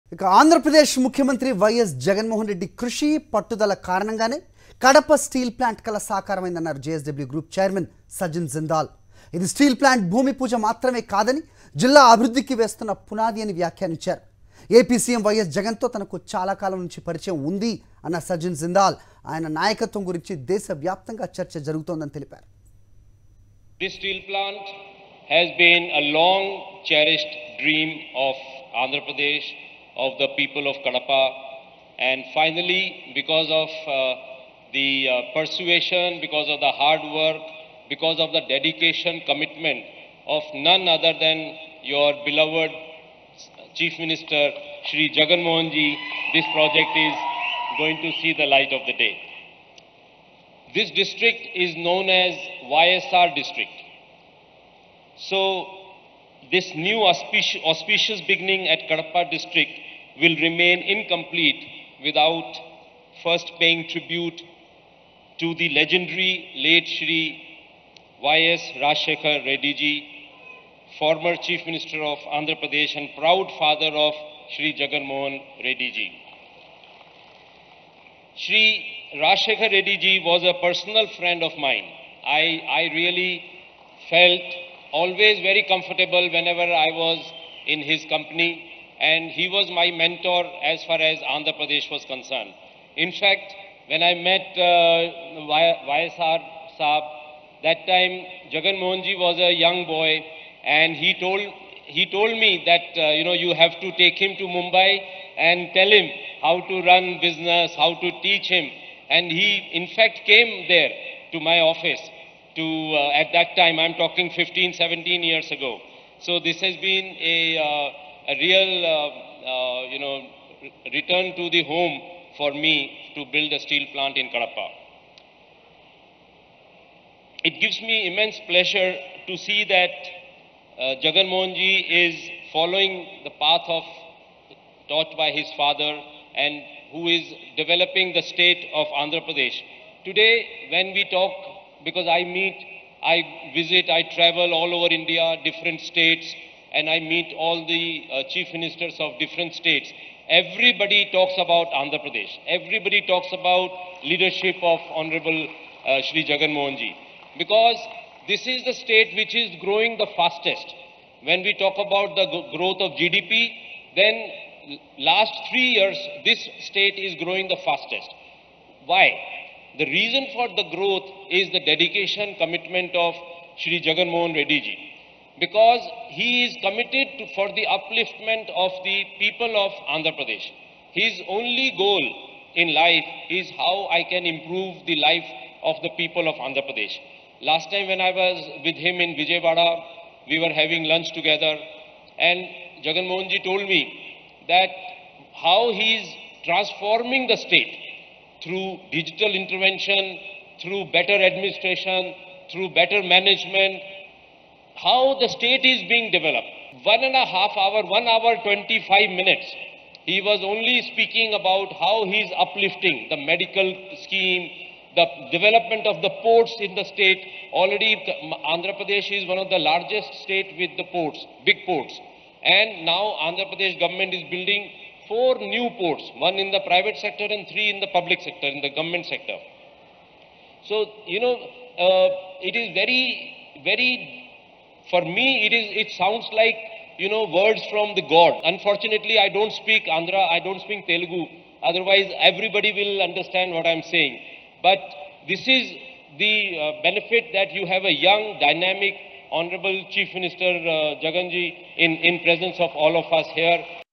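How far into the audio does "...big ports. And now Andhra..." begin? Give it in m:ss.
3:41.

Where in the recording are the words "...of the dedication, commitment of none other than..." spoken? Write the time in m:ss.
0:38.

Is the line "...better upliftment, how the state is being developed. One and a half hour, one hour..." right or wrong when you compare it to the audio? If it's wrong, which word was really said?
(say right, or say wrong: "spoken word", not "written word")
wrong: "management", not "upliftment".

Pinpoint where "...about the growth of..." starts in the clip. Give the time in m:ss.
2:41.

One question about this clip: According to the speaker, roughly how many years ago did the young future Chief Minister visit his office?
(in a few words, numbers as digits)
15 to 17 years.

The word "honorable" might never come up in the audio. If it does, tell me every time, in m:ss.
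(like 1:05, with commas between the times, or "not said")
2:34, 4:09.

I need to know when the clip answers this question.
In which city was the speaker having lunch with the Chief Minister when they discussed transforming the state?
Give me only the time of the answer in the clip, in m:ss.
3:09.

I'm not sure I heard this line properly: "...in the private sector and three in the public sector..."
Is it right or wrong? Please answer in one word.
right.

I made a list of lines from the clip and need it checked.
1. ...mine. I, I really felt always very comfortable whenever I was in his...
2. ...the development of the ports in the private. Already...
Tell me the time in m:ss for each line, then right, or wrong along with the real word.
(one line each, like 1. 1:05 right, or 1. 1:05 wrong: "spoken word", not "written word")
1. 1:21 right
2. 3:34 wrong: "state", not "private".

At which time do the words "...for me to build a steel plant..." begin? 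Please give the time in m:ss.
2:02.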